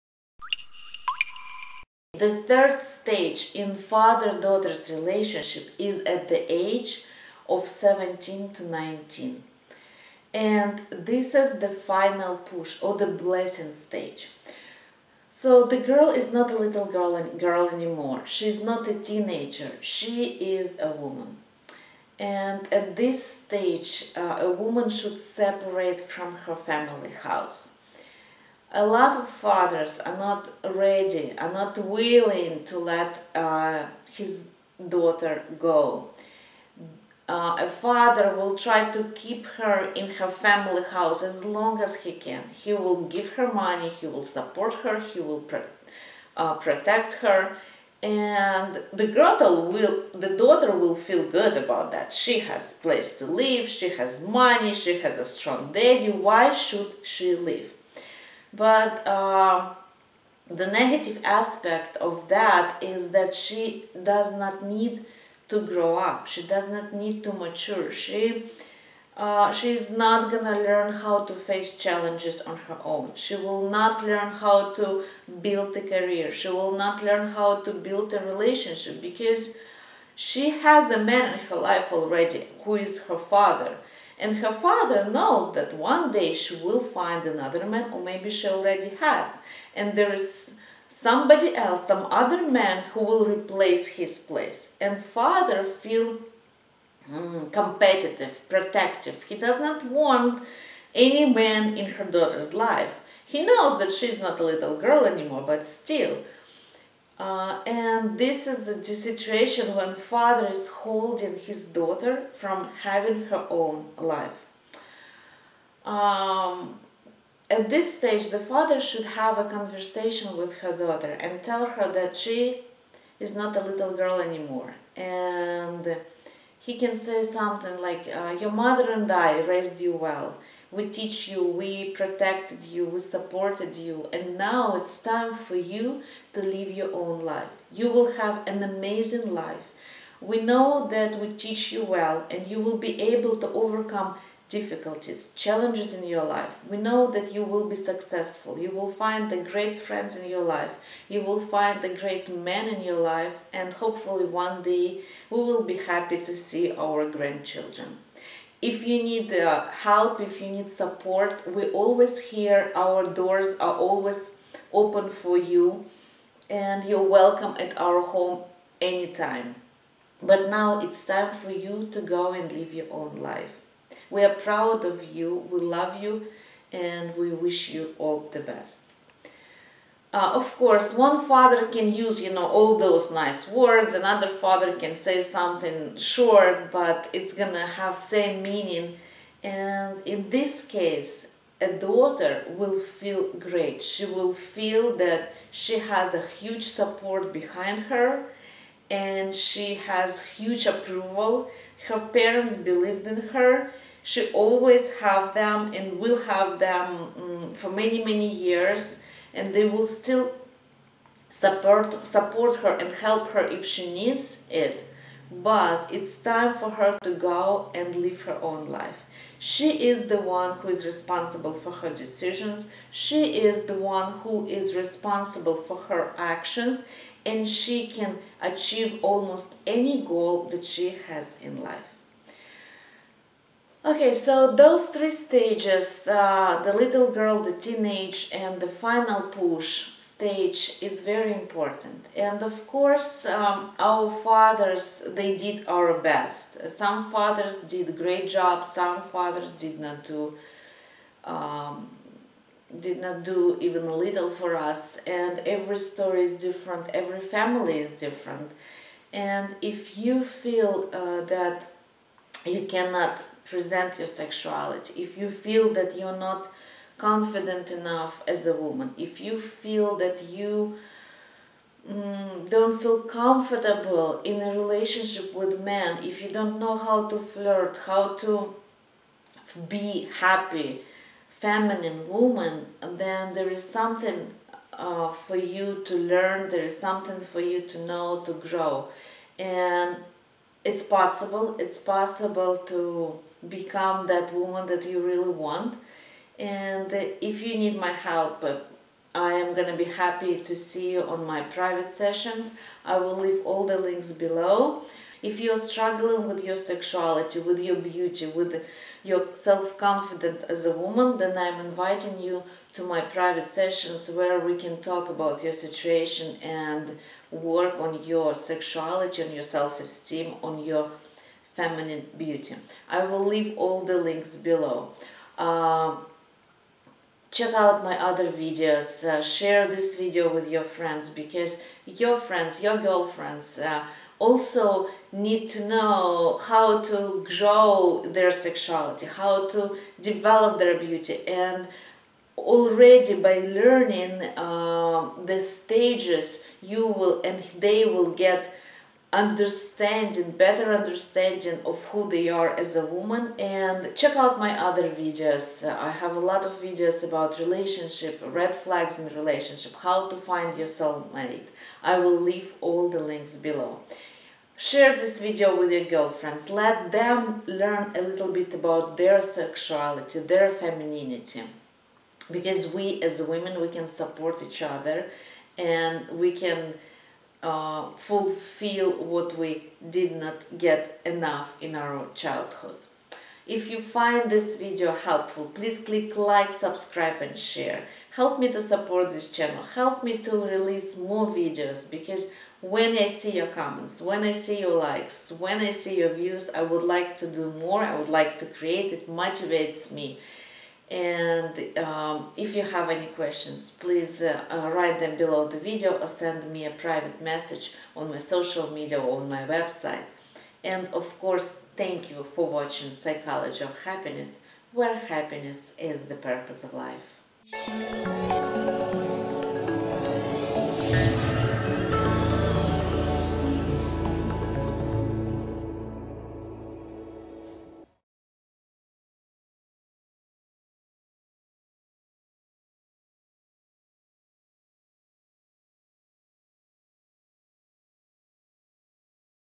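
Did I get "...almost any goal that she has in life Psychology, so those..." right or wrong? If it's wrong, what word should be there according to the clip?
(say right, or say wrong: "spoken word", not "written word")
wrong: "Okay", not "Psychology".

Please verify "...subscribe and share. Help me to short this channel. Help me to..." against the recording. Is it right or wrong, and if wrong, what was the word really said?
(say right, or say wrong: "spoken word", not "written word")
wrong: "support", not "short".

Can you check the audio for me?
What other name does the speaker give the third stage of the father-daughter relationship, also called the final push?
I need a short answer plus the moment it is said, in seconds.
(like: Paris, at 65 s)
The blessing stage, at 12 s.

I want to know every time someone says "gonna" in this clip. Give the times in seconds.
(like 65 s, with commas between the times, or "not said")
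70 s, 187 s, 299 s.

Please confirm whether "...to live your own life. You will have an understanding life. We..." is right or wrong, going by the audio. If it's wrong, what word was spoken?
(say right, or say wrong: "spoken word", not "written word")
wrong: "amazing", not "understanding".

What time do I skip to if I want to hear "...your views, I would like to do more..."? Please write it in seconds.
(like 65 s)
395 s.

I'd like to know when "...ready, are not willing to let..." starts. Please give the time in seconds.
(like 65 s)
30 s.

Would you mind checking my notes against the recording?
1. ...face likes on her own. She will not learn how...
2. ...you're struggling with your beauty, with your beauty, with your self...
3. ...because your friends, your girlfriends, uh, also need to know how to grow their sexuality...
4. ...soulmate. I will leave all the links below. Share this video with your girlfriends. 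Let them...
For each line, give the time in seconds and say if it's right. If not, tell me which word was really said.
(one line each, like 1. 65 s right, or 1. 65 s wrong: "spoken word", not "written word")
1. 71 s wrong: "challenges", not "likes"
2. 305 s wrong: "sexuality", not "beauty"
3. 331 s right
4. 360 s right.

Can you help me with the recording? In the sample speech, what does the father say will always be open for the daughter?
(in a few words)
Our doors.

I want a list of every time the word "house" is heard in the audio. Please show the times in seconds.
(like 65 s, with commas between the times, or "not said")
27 s, 40 s.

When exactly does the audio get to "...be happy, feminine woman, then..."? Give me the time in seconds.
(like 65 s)
279 s.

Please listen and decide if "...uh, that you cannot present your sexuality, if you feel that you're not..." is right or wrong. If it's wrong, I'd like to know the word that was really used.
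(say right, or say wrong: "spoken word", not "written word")
right.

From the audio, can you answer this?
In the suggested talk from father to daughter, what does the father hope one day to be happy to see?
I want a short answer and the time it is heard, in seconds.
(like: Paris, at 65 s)
Grandchildren, at 157 s.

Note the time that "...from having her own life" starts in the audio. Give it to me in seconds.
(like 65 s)
112 s.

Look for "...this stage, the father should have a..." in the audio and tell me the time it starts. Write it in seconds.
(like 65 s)
117 s.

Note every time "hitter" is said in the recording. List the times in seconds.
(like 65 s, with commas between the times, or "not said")
not said.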